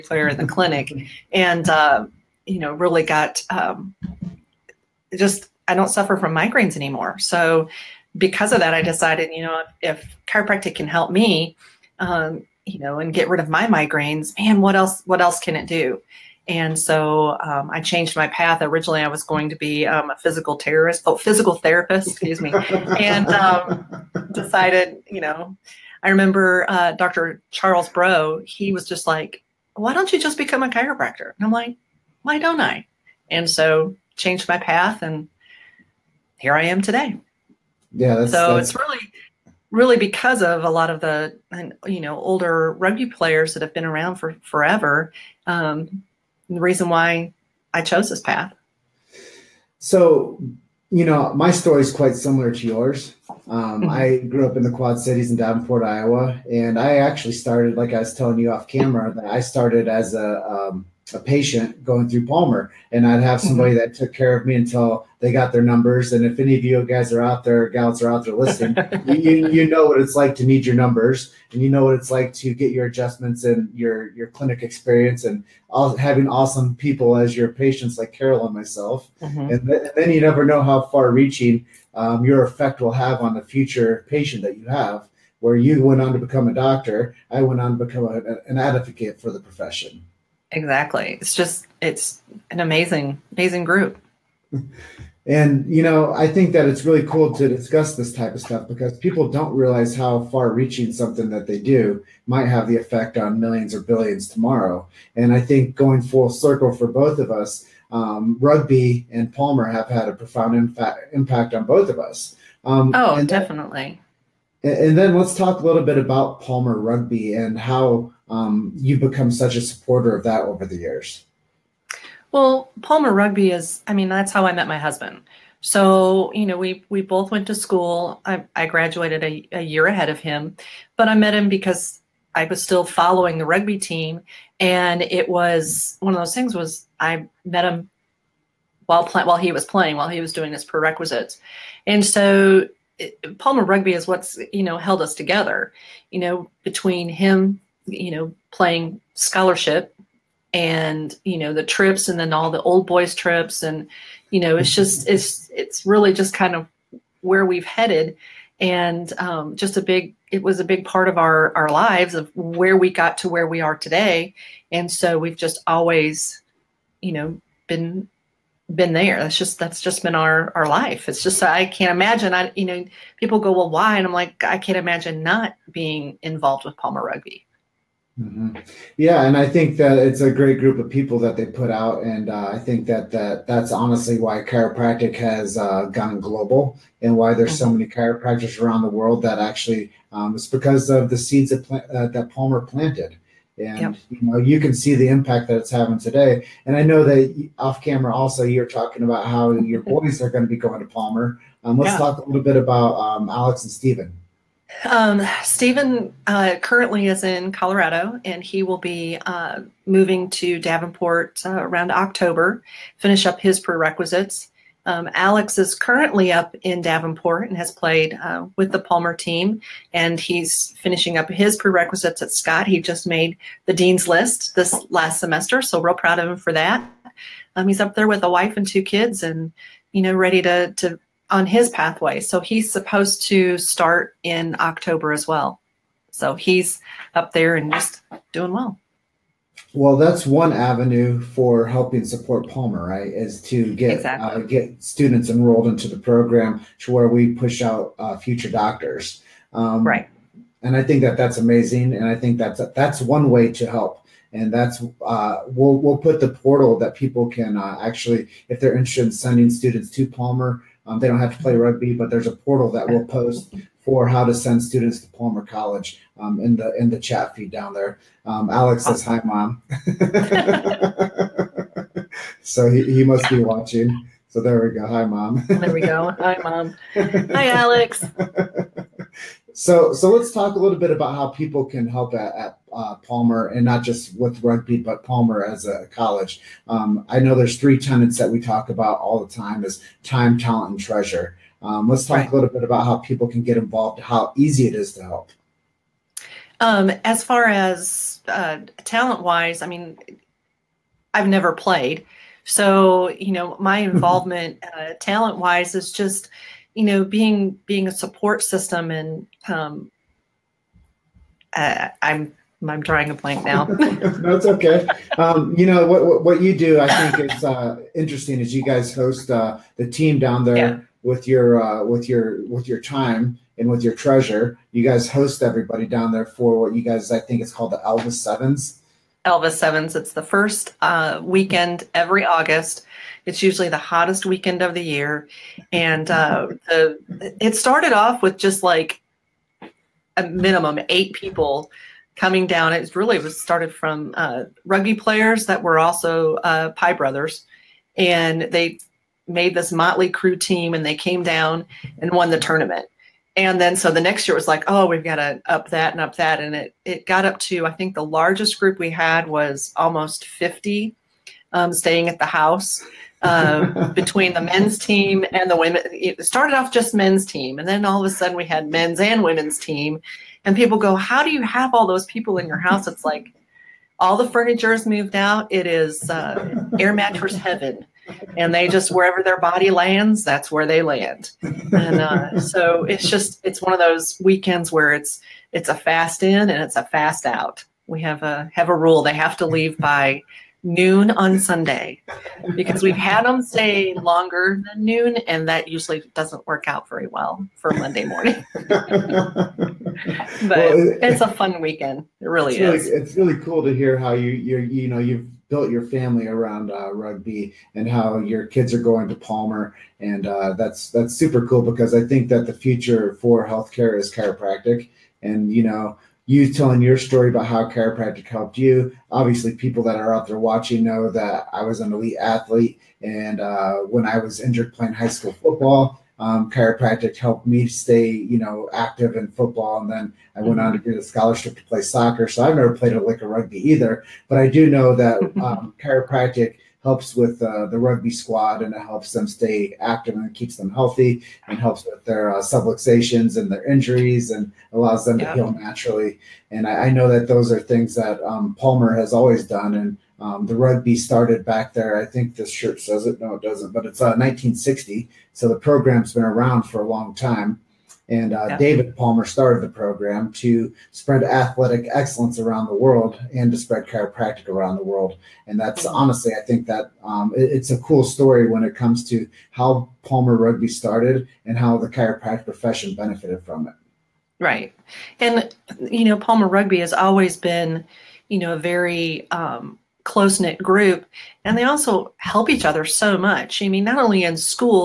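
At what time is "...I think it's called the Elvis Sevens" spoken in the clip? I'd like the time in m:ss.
5:27.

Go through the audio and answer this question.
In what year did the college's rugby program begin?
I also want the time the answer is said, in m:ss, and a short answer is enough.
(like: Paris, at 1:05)
1960, at 7:34.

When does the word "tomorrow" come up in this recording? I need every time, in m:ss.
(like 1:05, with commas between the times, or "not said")
1:44.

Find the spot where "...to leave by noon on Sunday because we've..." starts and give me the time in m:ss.
6:29.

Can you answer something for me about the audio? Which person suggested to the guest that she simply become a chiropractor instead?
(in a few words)
Dr. Charles Bro.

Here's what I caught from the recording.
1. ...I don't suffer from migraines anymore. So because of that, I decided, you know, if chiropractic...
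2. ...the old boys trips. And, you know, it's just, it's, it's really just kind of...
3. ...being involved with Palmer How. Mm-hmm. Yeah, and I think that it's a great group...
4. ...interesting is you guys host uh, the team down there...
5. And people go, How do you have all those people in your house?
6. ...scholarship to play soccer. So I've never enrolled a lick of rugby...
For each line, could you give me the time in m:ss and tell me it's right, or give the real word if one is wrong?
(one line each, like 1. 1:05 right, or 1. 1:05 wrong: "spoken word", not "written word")
1. 0:05 right
2. 2:32 right
3. 2:55 wrong: "Rugby", not "How"
4. 5:17 right
5. 6:10 right
6. 7:11 wrong: "played", not "enrolled".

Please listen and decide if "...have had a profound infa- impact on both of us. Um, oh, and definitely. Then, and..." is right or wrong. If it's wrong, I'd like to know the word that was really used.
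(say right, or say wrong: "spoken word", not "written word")
right.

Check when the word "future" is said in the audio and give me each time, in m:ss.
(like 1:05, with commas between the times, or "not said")
1:23, 4:08, 6:52.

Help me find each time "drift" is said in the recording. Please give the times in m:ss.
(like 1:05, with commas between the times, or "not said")
not said.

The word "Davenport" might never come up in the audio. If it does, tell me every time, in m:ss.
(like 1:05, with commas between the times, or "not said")
0:55, 3:30, 3:36.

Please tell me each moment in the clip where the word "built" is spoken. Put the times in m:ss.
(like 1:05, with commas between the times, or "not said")
6:45.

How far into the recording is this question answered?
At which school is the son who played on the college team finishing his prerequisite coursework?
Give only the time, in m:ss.
3:42.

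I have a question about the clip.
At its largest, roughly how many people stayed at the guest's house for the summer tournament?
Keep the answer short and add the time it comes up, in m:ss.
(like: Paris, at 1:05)
50, at 6:00.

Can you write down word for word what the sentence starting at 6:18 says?
And they just, wherever their body lands, that's where they land.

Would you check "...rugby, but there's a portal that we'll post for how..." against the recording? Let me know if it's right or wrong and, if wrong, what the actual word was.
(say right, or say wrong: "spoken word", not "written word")
right.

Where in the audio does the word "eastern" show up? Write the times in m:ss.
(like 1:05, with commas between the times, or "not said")
not said.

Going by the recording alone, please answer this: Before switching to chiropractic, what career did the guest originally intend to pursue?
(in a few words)
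Physical therapist.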